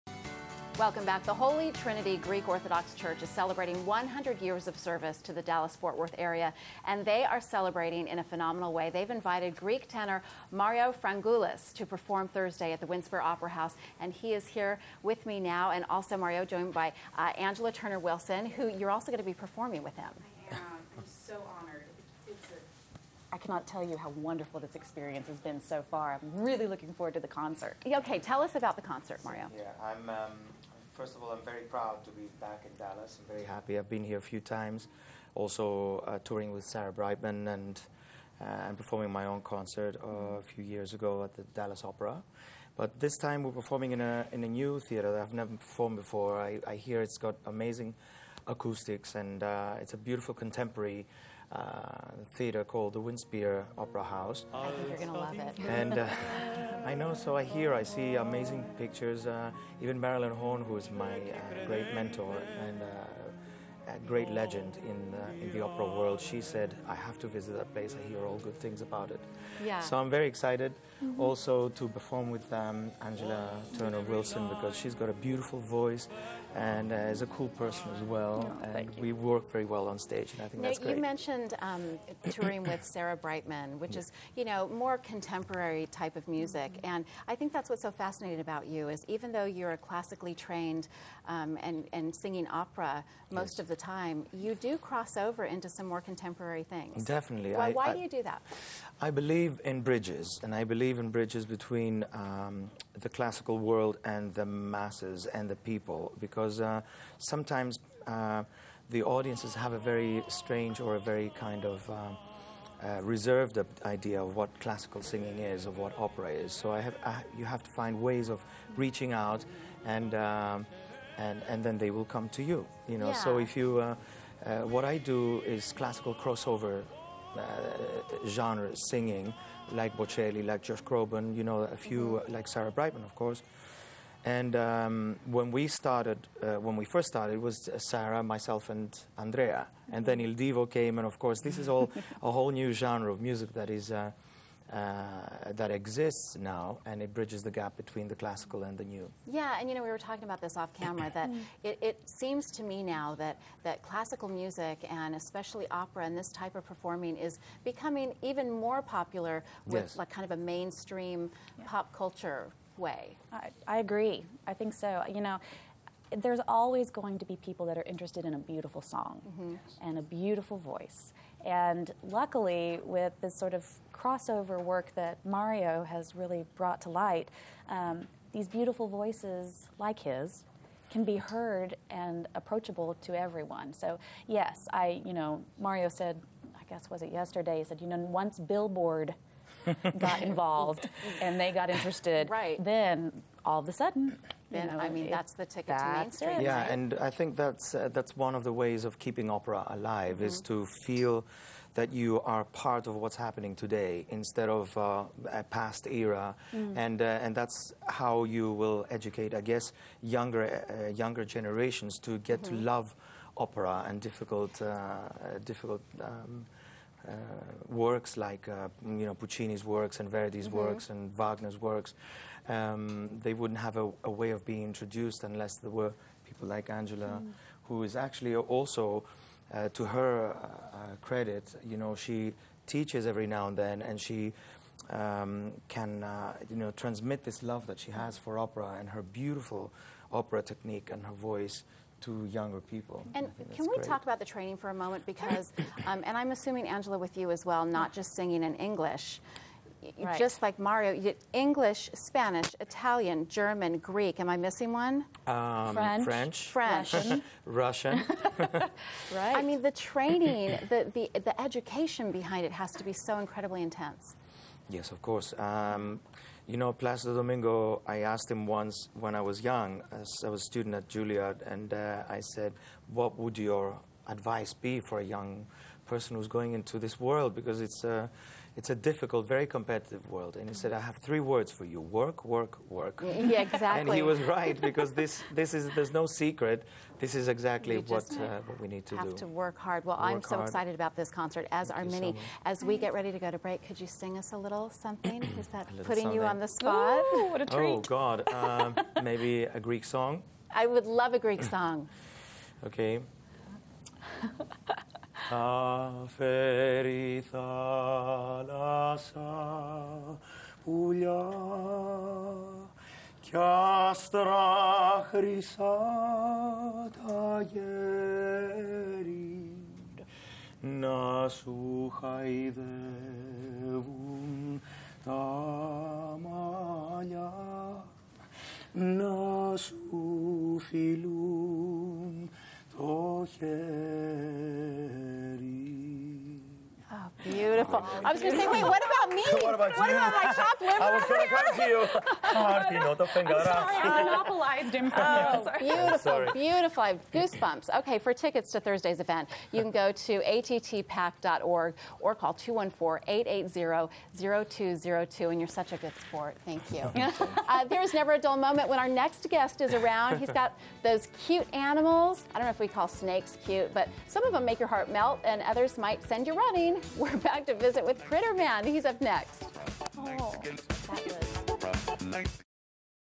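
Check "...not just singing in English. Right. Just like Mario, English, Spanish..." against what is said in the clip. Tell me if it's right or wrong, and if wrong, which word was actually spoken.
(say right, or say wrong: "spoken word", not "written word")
right.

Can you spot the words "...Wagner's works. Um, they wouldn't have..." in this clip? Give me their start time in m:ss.
3:41.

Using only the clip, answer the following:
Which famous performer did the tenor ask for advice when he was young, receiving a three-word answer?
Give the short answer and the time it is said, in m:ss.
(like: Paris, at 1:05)
Placido Domingo, at 4:26.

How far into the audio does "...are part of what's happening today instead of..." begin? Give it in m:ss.
3:22.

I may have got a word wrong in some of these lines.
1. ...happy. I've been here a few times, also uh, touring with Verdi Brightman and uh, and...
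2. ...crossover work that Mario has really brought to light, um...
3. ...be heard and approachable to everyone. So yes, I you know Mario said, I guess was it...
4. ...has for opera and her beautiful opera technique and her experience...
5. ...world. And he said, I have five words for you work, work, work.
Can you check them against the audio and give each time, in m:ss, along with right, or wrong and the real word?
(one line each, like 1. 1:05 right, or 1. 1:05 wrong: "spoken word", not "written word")
1. 0:33 wrong: "Sarah", not "Verdi"
2. 2:53 right
3. 3:01 right
4. 3:57 wrong: "voice", not "experience"
5. 4:40 wrong: "three", not "five".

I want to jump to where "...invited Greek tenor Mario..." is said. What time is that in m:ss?
0:09.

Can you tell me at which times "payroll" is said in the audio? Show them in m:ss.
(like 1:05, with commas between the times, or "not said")
not said.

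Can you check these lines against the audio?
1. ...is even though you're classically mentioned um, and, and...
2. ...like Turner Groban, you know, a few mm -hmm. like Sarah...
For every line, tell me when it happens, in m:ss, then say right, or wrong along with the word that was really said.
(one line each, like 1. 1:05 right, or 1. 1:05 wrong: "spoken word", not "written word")
1. 1:28 wrong: "trained", not "mentioned"
2. 2:10 wrong: "Josh", not "Turner".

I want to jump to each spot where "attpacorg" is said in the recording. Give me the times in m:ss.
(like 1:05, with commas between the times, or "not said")
5:50.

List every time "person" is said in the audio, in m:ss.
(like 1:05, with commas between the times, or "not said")
1:17, 4:35.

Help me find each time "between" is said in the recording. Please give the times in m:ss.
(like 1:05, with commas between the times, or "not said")
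1:41, 2:27.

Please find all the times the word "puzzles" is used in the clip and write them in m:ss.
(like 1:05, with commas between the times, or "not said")
not said.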